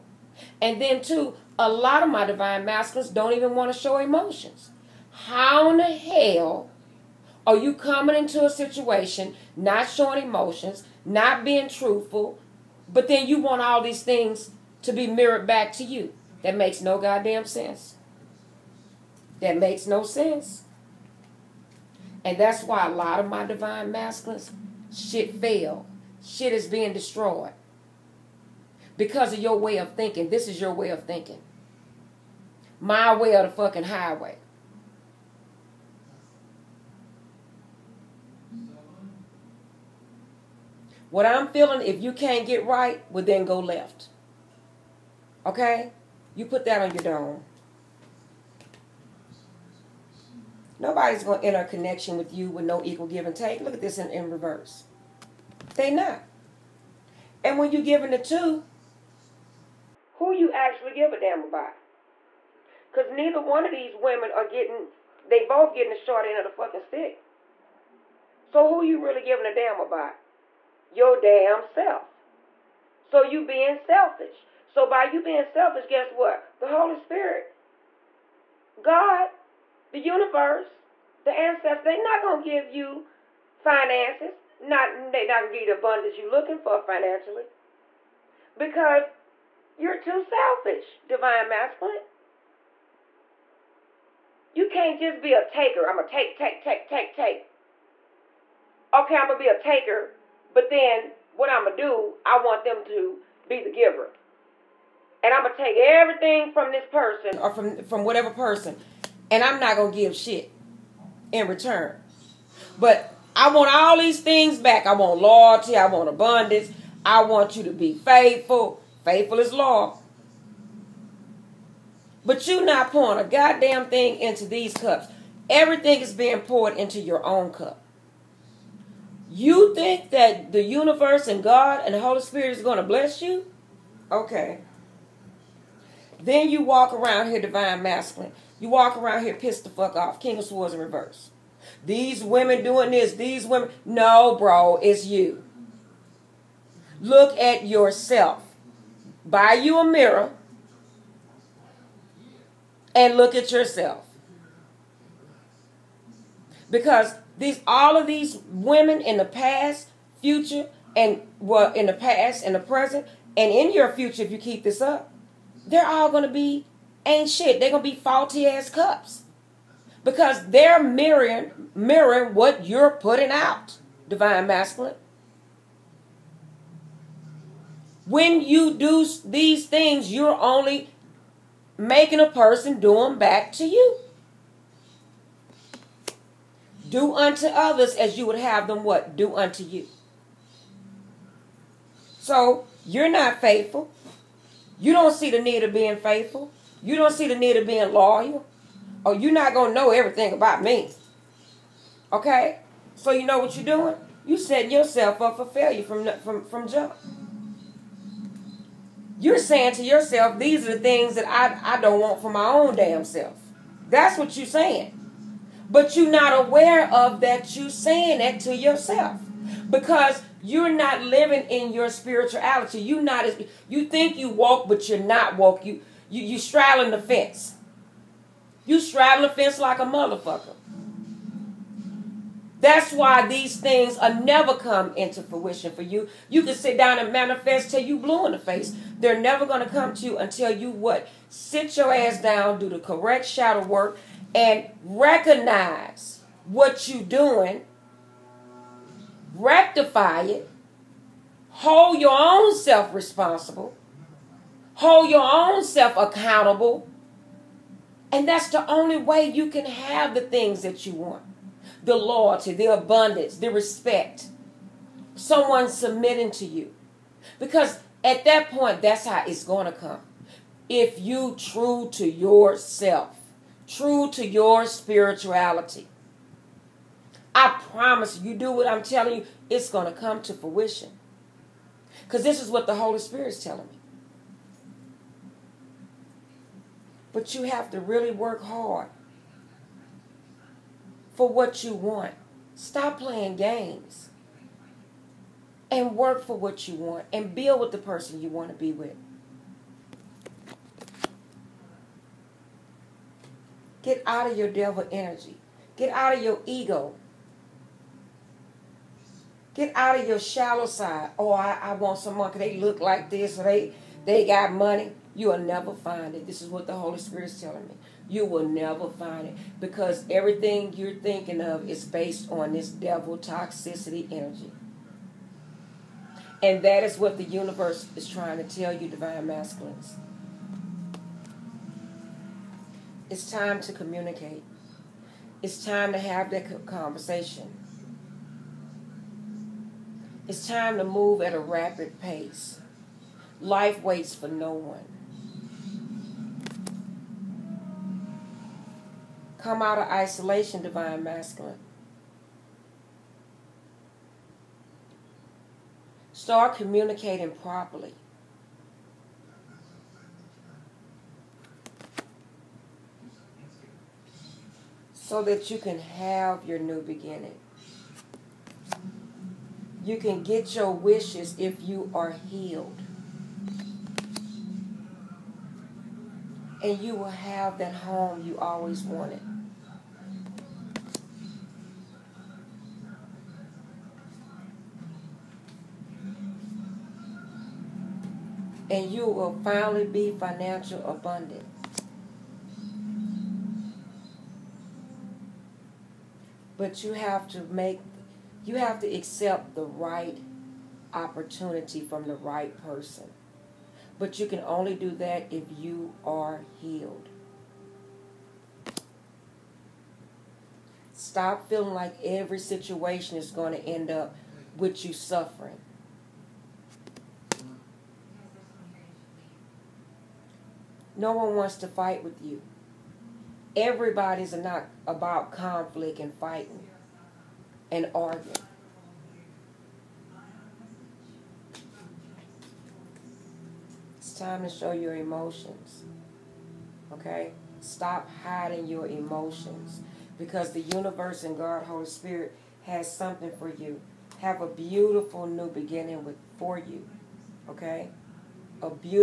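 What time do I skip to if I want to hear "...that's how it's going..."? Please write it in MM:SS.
04:28.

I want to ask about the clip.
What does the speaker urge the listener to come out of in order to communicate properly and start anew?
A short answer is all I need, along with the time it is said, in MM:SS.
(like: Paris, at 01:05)
Isolation, at 05:49.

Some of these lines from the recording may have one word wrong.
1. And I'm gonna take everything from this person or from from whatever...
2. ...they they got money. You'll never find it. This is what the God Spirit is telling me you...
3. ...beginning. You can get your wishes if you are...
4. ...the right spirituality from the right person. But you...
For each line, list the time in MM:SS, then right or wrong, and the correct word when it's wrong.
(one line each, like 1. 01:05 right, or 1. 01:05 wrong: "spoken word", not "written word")
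1. 01:45 right
2. 05:13 wrong: "Holy", not "God"
3. 06:06 right
4. 06:39 wrong: "opportunity", not "spirituality".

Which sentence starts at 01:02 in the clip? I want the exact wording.
Because neither one of these women are getting, they both getting the short end of the fucking stick.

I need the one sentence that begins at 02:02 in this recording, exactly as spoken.
But you not pouring a goddamn thing into these cups.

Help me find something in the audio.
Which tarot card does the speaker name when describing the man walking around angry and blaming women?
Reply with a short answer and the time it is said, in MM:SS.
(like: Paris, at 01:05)
King of Swords in reverse, at 02:20.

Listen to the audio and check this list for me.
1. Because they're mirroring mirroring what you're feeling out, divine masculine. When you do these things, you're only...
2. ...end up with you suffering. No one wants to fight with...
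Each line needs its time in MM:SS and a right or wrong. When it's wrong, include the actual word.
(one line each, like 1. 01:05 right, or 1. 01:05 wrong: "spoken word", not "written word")
1. 02:50 wrong: "putting", not "feeling"
2. 06:53 right.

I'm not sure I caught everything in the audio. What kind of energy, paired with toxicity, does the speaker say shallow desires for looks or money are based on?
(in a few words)
Devil toxicity energy.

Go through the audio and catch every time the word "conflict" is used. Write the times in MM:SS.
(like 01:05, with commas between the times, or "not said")
07:05.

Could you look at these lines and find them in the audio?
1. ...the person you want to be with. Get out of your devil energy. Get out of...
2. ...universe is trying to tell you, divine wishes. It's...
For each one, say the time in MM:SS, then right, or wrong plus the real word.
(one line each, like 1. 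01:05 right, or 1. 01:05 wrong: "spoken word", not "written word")
1. 04:57 right
2. 05:27 wrong: "masculines", not "wishes".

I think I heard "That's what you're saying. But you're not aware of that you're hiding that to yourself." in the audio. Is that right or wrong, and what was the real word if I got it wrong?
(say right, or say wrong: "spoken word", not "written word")
wrong: "saying", not "hiding".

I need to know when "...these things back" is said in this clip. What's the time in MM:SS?
01:53.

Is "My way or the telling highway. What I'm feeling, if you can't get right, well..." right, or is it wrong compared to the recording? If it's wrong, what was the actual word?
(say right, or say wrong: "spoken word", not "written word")
wrong: "fucking", not "telling".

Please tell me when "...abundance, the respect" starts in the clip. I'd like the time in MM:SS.
04:22.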